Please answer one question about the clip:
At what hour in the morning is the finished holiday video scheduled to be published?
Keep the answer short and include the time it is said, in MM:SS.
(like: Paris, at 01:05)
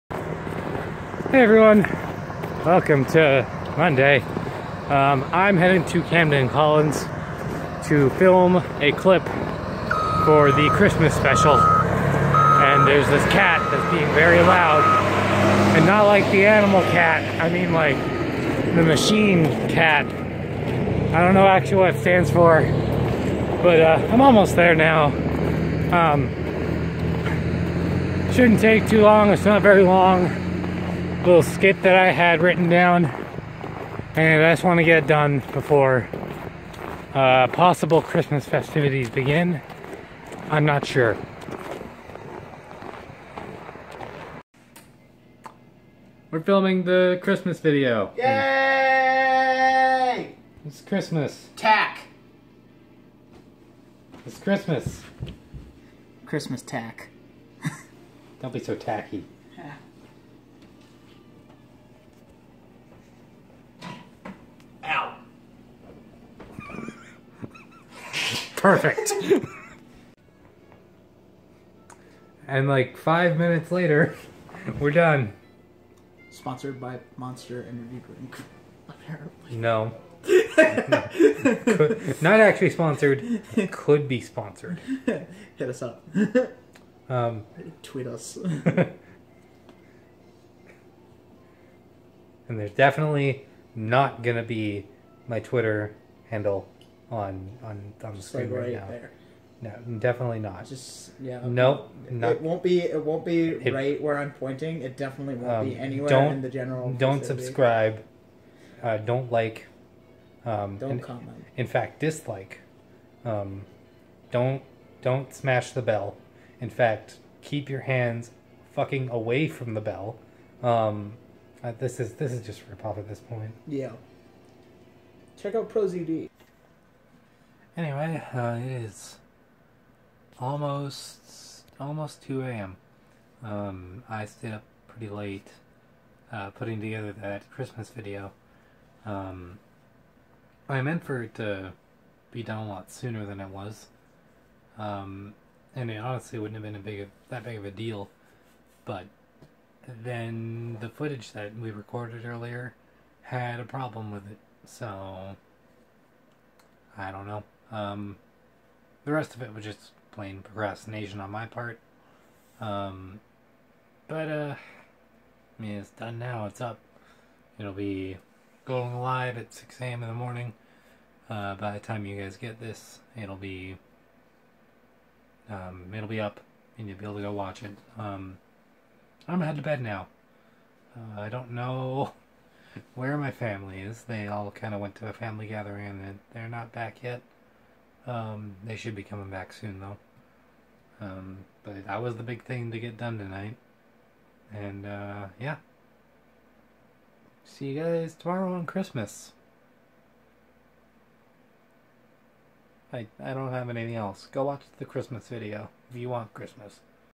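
6 a.m., at 02:49.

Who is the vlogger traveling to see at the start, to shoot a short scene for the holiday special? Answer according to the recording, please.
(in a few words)
Camden Collins.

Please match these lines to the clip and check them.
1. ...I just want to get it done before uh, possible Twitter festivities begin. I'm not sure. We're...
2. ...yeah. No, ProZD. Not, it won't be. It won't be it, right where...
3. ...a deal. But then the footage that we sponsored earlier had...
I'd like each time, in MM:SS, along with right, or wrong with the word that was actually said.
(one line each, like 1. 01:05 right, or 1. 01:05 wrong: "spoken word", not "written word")
1. 00:34 wrong: "Christmas", not "Twitter"
2. 01:41 wrong: "Nope", not "ProZD"
3. 02:27 wrong: "recorded", not "sponsored".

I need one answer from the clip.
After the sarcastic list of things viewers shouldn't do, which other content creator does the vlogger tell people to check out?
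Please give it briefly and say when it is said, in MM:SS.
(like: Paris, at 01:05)
ProZD, at 02:05.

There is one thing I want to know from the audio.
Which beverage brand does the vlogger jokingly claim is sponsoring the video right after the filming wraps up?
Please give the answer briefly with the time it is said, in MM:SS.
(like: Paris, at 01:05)
Monster Energy Drink, at 01:17.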